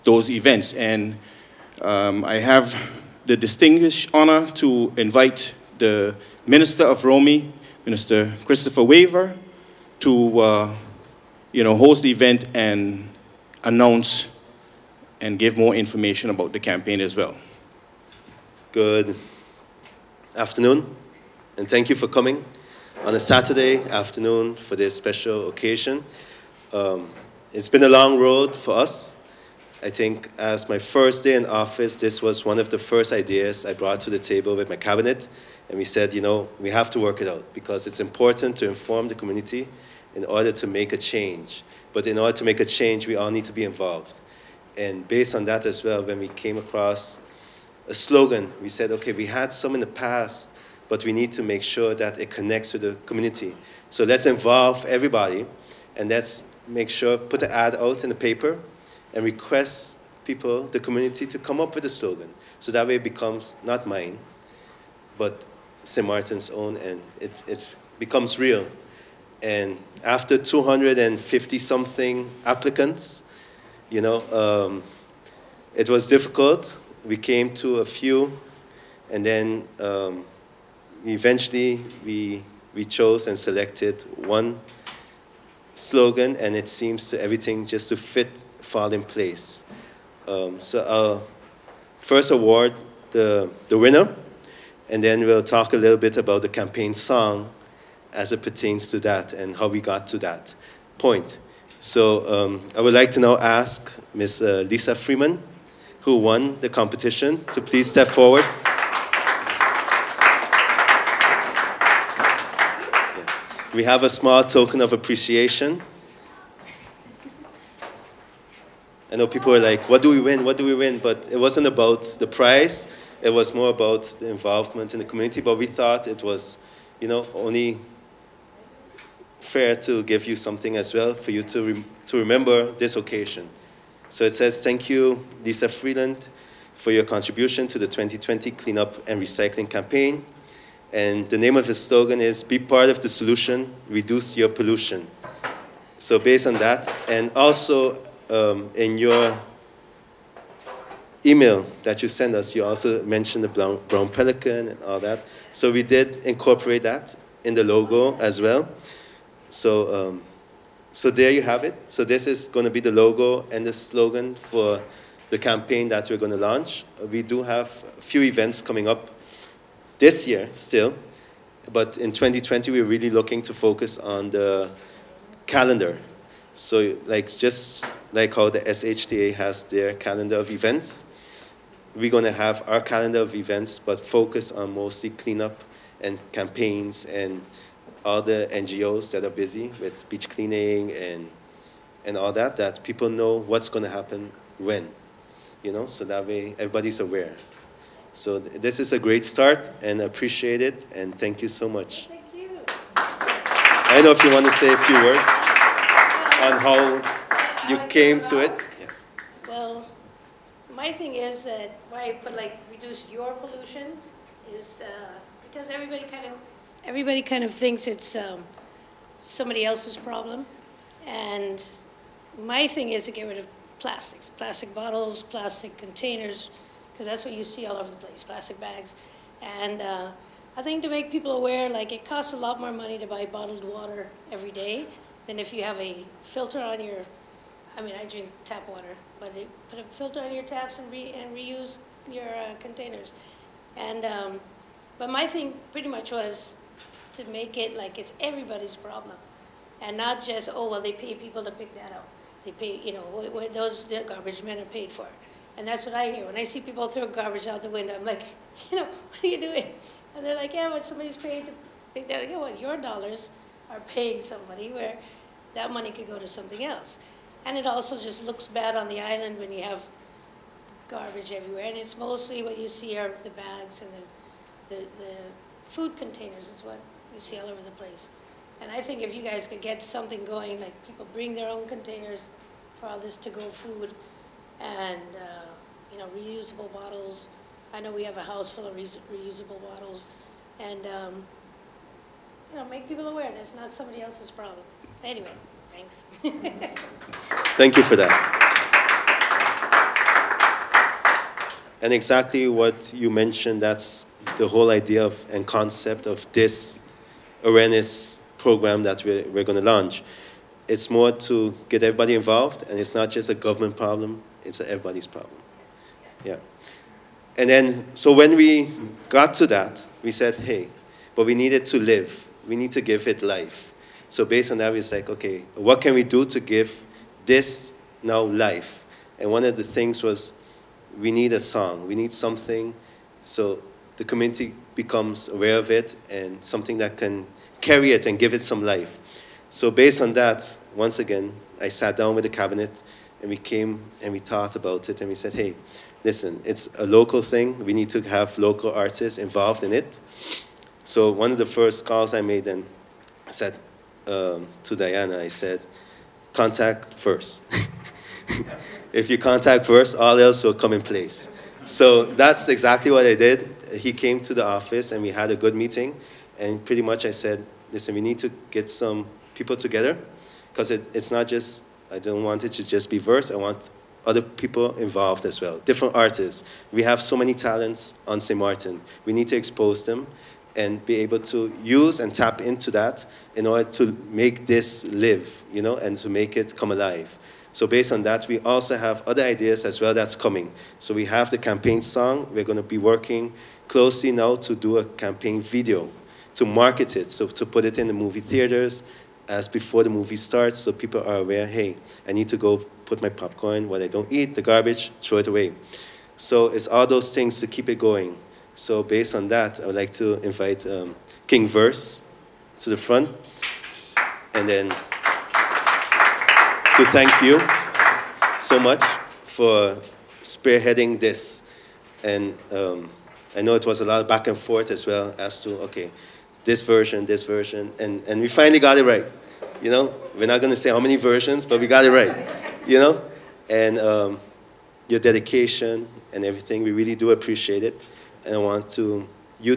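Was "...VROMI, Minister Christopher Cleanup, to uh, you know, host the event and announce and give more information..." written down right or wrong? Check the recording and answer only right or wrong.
wrong.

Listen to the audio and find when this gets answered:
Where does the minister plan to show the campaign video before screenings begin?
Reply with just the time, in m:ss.
6:37.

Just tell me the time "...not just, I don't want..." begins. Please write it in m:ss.
6:11.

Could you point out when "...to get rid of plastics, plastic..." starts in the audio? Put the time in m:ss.
3:43.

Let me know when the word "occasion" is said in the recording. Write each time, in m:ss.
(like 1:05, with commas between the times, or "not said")
0:25, 2:12.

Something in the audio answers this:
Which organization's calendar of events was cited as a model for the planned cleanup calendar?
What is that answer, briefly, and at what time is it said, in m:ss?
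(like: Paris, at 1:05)
SHTA, at 2:58.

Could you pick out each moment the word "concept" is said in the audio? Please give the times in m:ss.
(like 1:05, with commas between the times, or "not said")
5:05.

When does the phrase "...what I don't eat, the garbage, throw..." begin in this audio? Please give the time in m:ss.
6:43.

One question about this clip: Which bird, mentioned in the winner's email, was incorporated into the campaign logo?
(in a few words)
Brown pelican.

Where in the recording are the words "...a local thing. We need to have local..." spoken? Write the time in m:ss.
5:46.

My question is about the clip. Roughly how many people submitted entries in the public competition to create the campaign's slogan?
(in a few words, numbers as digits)
250.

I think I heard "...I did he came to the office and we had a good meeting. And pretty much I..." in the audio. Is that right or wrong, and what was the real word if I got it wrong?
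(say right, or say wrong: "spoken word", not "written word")
right.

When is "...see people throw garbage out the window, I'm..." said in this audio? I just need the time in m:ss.
4:16.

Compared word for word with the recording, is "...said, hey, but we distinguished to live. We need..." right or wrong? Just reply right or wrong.
wrong.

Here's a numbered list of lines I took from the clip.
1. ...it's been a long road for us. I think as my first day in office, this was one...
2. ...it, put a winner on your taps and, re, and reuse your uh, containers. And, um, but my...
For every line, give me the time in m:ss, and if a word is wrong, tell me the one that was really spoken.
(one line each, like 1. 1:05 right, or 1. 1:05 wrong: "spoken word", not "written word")
1. 0:27 right
2. 3:59 wrong: "filter", not "winner".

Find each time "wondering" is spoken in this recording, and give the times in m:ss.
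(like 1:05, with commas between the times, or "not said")
not said.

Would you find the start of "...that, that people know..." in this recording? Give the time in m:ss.
3:12.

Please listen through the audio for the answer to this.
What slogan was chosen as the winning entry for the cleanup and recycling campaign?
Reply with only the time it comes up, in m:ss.
2:22.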